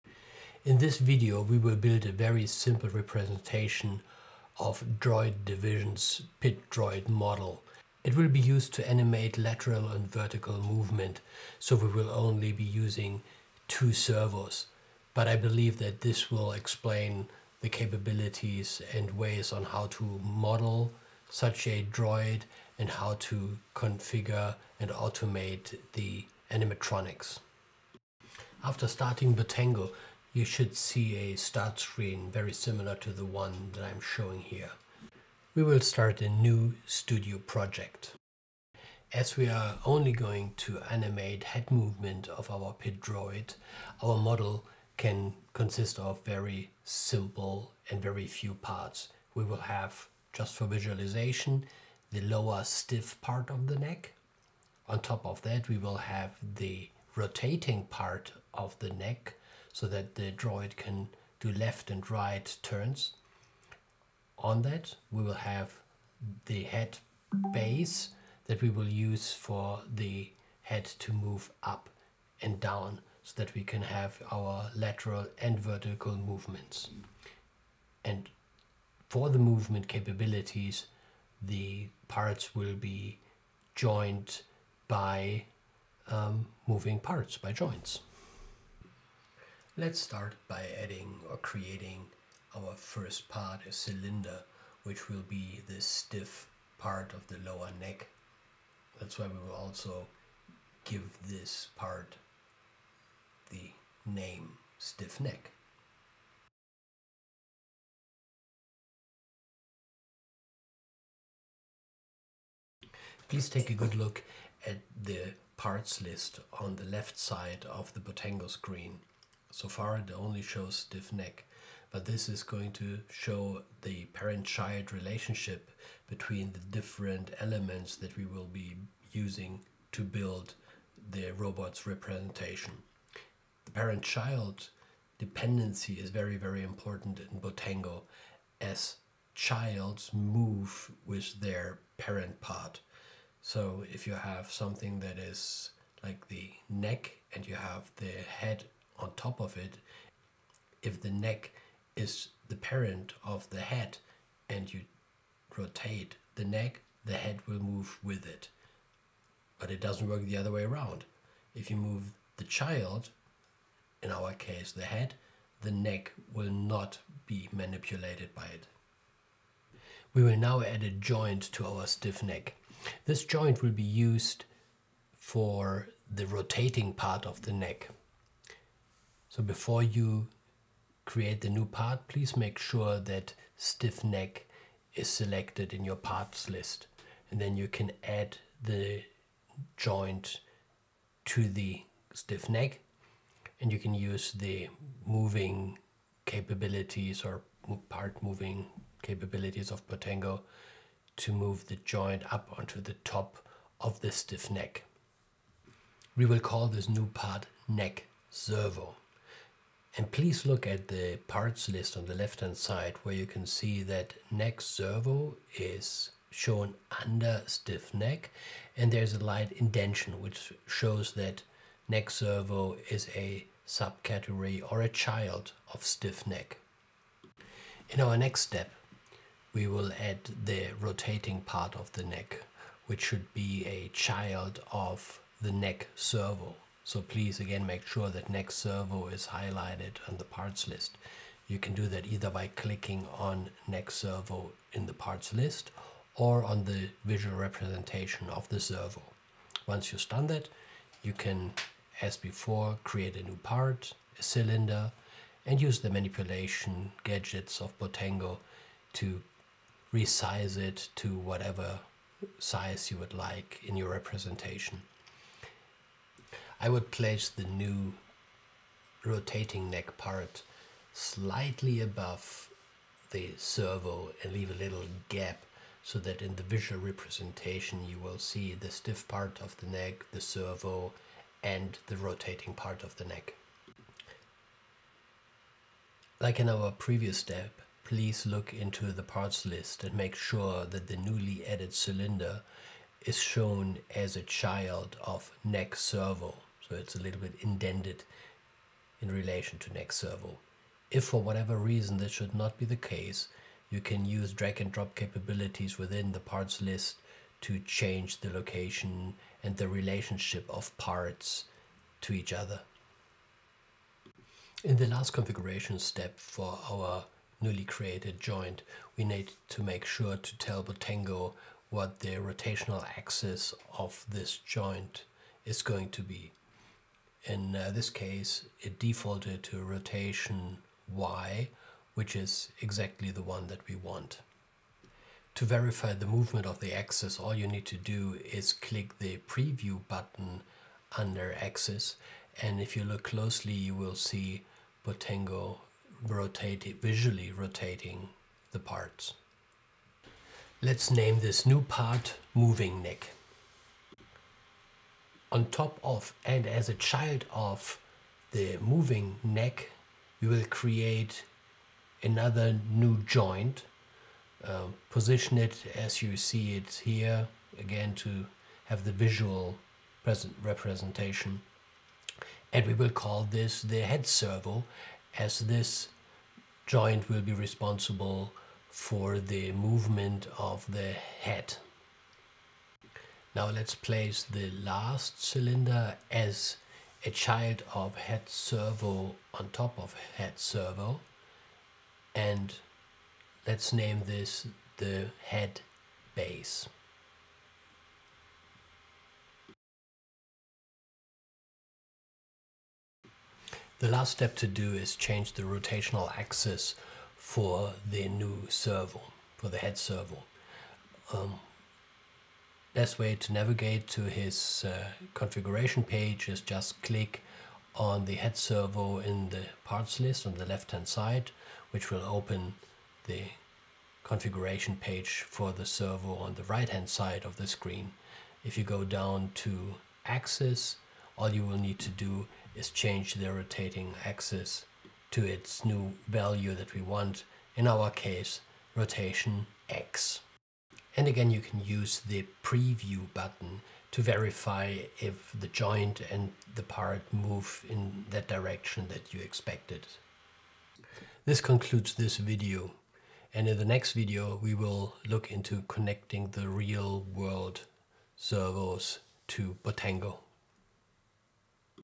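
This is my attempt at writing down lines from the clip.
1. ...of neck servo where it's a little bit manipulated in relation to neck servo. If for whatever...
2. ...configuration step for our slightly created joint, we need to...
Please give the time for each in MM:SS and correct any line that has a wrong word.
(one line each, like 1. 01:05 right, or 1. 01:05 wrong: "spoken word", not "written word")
1. 04:55 wrong: "indented", not "manipulated"
2. 05:15 wrong: "newly", not "slightly".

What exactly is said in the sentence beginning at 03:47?
In our next step we will add the rotating part of the neck which should be a child of the neck servo.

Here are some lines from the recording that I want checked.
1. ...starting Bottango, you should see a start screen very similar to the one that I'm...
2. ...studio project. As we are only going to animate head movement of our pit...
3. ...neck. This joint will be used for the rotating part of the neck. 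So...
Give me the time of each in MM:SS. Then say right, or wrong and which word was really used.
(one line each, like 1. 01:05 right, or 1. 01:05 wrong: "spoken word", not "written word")
1. 00:28 right
2. 00:36 right
3. 02:52 right.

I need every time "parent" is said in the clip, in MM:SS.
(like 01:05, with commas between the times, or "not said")
02:04, 02:13, 02:21, 02:32.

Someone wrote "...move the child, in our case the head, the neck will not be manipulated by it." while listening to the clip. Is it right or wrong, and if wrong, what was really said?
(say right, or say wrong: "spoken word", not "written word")
right.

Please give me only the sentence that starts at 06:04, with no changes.
Uh, position it as you see it here, again to have the visual present representation.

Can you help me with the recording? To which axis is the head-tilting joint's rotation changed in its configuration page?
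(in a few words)
rotation x.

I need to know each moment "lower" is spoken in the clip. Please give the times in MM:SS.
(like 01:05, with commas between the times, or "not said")
00:52, 01:37.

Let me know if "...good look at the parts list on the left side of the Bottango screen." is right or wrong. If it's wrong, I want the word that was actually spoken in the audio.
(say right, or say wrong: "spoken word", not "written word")
right.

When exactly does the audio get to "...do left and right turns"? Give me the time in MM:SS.
01:01.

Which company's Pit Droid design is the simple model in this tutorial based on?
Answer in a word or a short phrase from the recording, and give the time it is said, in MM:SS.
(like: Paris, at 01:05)
Droid Division, at 00:04.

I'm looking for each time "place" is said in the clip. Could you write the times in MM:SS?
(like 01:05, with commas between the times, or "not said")
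04:26, 06:23.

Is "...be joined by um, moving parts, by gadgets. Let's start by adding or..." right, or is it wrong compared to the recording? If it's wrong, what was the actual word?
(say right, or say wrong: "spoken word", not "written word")
wrong: "joints", not "gadgets".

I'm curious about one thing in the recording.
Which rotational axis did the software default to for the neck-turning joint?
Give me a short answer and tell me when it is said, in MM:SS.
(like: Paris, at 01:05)
rotation y, at 05:29.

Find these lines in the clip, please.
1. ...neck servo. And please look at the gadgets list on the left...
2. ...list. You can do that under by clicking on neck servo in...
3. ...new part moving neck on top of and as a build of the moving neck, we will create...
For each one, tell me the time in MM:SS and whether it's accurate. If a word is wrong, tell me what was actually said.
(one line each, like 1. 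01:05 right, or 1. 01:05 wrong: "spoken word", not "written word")
1. 03:27 wrong: "parts", not "gadgets"
2. 04:00 wrong: "either", not "under"
3. 05:51 wrong: "child", not "build".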